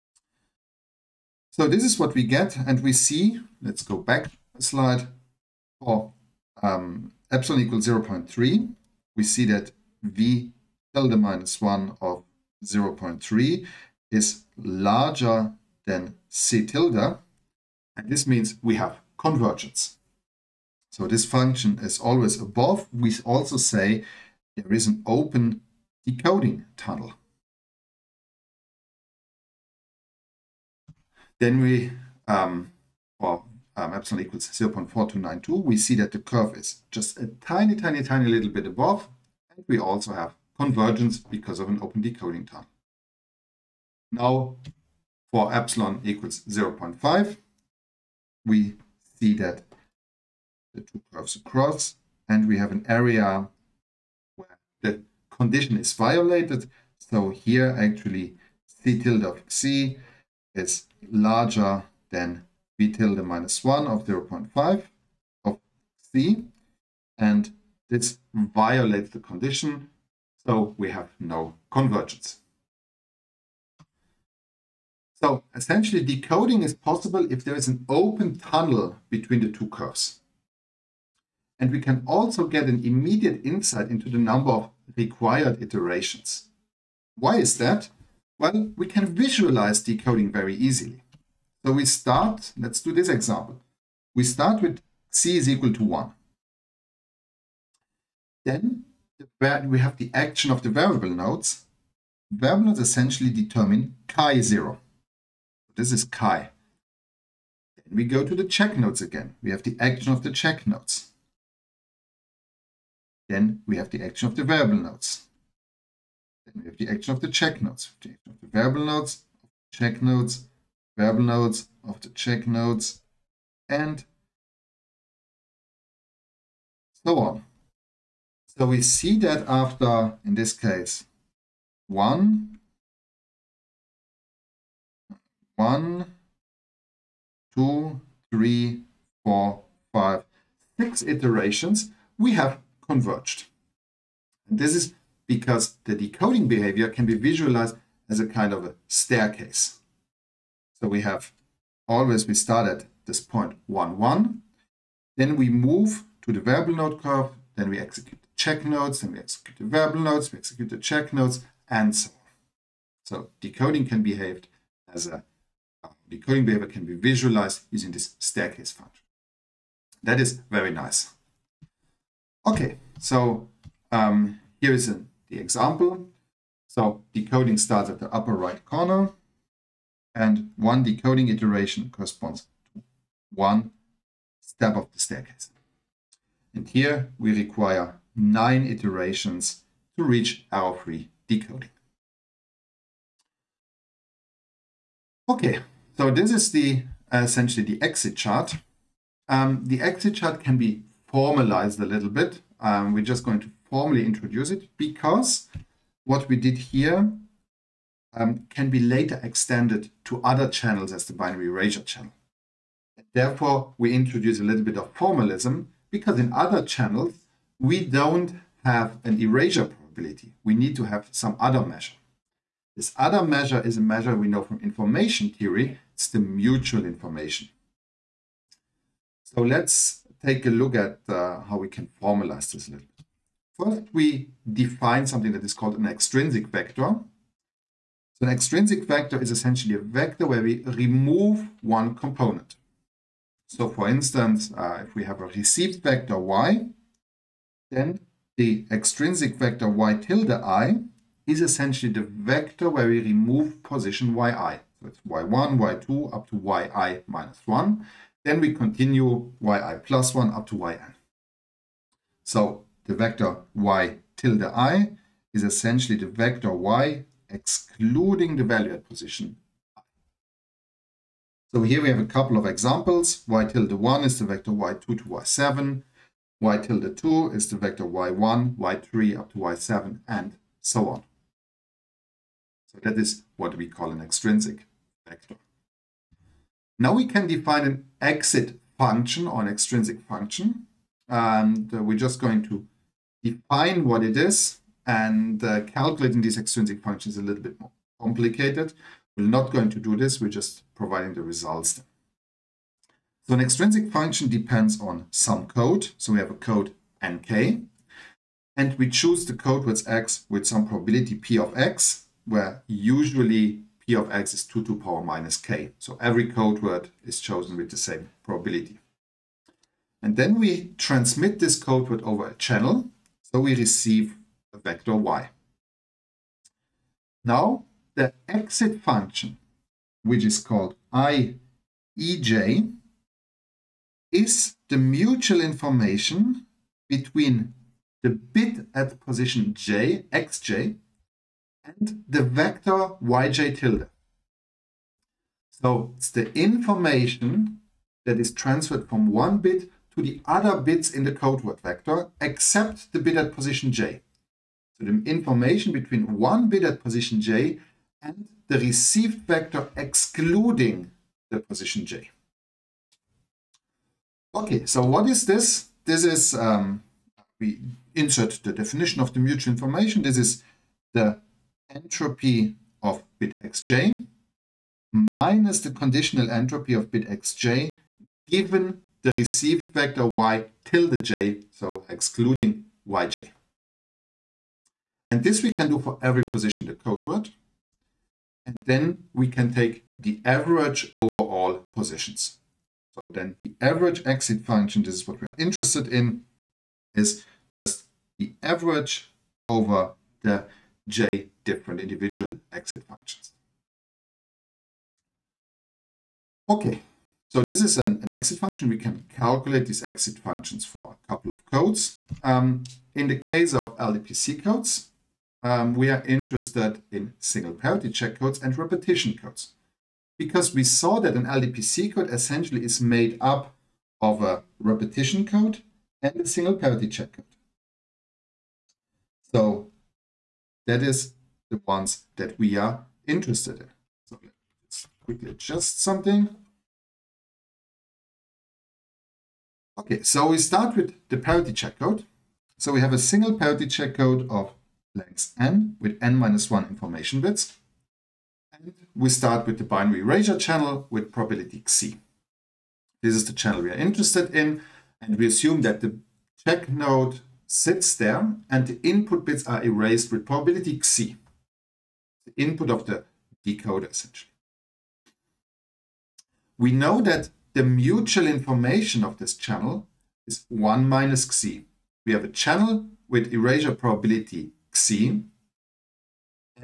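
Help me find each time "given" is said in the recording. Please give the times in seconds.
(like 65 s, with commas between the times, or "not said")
378 s.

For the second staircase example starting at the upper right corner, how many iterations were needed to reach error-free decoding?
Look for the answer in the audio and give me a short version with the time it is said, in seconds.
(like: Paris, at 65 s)
9, at 188 s.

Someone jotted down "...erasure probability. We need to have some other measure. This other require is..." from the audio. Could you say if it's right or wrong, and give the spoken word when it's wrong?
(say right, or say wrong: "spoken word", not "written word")
wrong: "measure", not "require".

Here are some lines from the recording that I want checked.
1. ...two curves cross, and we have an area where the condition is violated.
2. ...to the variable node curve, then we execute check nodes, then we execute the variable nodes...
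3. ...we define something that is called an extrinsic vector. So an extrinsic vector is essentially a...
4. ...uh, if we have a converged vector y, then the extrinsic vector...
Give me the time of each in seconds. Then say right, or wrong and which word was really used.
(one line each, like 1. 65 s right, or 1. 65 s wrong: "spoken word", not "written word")
1. 50 s right
2. 156 s right
3. 233 s right
4. 244 s wrong: "received", not "converged".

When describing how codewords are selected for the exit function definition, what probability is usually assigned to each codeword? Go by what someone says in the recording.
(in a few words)
2 to the power minus k.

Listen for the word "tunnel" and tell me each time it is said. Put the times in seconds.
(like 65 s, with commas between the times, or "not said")
26 s, 78 s.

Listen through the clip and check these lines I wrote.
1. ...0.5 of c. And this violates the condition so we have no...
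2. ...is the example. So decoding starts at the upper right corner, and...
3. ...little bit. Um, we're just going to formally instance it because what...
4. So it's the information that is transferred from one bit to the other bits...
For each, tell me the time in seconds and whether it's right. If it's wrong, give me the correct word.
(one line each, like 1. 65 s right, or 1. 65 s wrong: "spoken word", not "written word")
1. 64 s right
2. 174 s right
3. 201 s wrong: "introduce", not "instance"
4. 345 s right.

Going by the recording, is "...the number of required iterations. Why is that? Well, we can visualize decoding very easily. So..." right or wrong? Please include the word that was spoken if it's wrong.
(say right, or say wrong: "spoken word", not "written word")
right.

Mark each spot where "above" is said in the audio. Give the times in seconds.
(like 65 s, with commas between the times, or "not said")
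22 s, 38 s.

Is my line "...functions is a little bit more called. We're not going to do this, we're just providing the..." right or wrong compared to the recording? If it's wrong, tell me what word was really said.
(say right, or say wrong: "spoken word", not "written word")
wrong: "complicated", not "called".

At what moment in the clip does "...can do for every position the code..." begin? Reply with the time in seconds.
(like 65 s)
385 s.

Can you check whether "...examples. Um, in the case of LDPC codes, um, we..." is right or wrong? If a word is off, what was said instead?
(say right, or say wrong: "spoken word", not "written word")
wrong: "codes", not "examples".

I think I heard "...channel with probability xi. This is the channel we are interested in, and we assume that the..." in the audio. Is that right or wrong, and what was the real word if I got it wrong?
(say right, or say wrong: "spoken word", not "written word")
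right.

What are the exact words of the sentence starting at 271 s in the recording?
So here we have a couple of examples.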